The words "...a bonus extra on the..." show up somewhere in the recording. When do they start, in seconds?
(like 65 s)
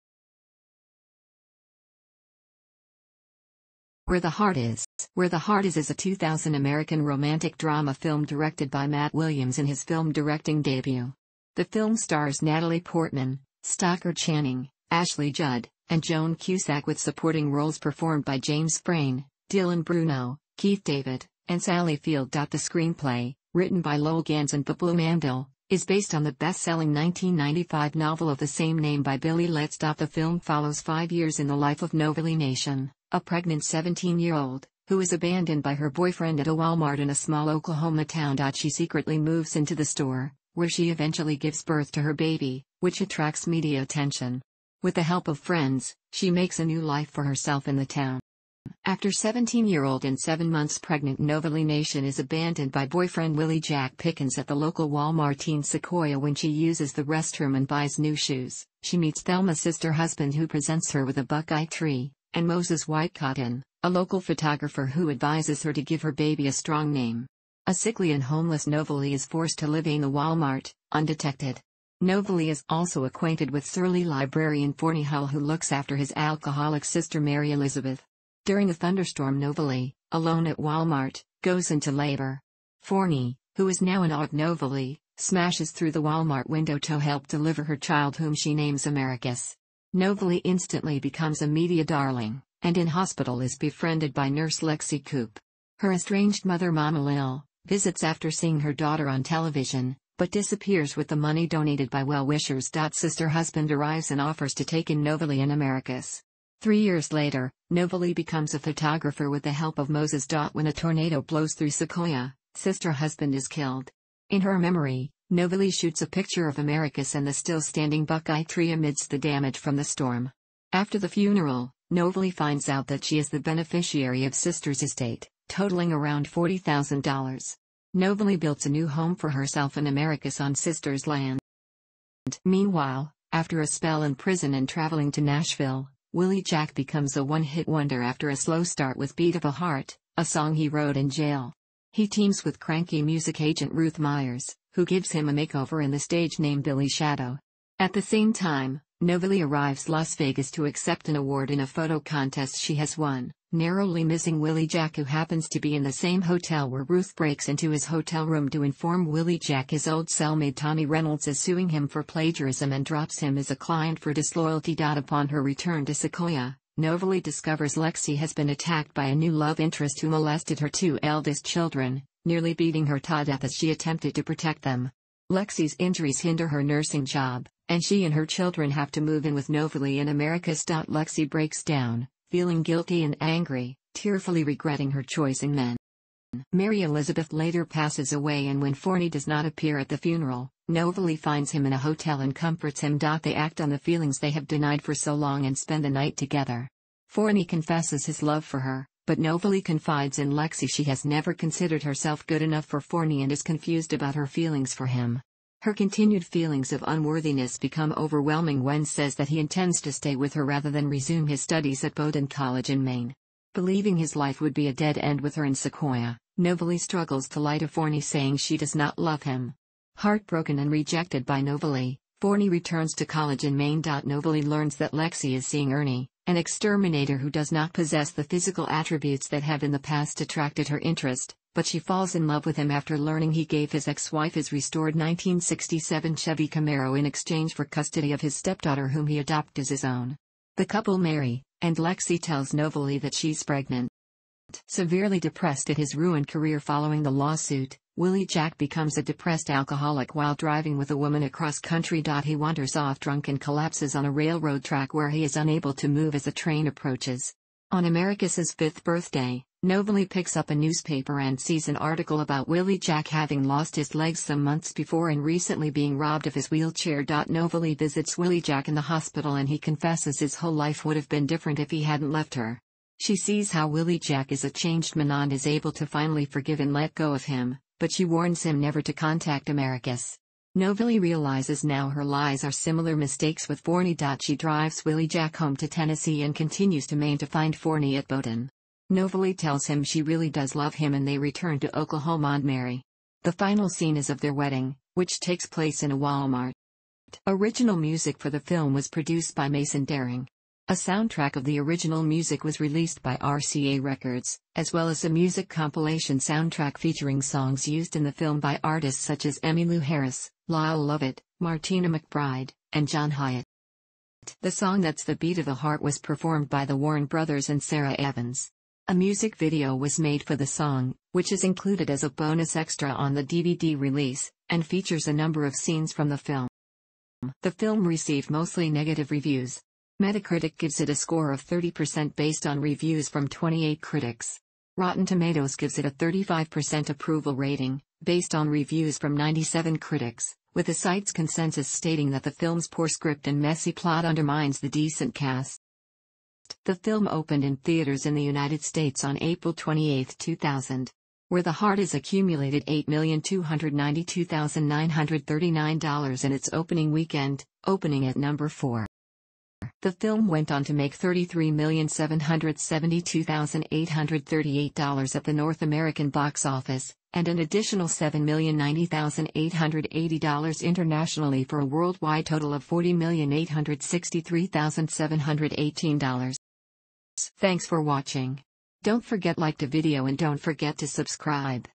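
322 s.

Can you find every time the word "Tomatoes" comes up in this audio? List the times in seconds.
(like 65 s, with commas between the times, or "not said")
335 s.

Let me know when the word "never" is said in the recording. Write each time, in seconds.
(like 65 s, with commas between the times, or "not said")
201 s, 278 s.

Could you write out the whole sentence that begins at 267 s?
Novalee visits Willy Jack in the hospital and he confesses his whole life would have been different if he hadn't left her.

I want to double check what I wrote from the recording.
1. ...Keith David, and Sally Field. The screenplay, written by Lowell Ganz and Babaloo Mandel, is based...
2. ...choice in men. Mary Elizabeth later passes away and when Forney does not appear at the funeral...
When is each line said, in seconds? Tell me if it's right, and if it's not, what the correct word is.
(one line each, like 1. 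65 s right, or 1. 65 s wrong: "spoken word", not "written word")
1. 20 s right
2. 185 s right.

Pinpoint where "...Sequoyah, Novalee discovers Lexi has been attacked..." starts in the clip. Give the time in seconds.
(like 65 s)
165 s.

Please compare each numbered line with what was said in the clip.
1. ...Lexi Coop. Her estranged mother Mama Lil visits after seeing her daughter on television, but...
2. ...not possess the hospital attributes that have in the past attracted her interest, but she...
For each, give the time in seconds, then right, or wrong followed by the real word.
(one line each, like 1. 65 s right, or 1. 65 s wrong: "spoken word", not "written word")
1. 94 s right
2. 227 s wrong: "physical", not "hospital".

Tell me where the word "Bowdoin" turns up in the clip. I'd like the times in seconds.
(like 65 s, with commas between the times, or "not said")
211 s, 288 s.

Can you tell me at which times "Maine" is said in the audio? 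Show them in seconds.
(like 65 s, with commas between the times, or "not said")
212 s, 223 s, 286 s.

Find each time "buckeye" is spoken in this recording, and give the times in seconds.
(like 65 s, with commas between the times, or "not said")
61 s, 118 s.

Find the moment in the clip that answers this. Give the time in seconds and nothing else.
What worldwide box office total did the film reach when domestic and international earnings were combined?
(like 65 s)
372 s.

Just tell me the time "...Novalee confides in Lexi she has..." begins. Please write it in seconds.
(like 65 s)
199 s.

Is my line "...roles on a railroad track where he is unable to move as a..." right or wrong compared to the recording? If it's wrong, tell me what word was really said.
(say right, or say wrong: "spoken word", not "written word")
wrong: "collapses", not "roles".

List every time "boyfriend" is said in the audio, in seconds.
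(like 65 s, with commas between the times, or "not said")
35 s, 52 s.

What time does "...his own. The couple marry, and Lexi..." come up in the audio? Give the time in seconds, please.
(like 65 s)
239 s.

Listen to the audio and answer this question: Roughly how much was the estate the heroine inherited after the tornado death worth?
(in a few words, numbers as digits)
$40,000.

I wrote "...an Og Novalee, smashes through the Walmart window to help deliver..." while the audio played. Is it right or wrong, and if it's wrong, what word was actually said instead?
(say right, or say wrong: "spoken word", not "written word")
right.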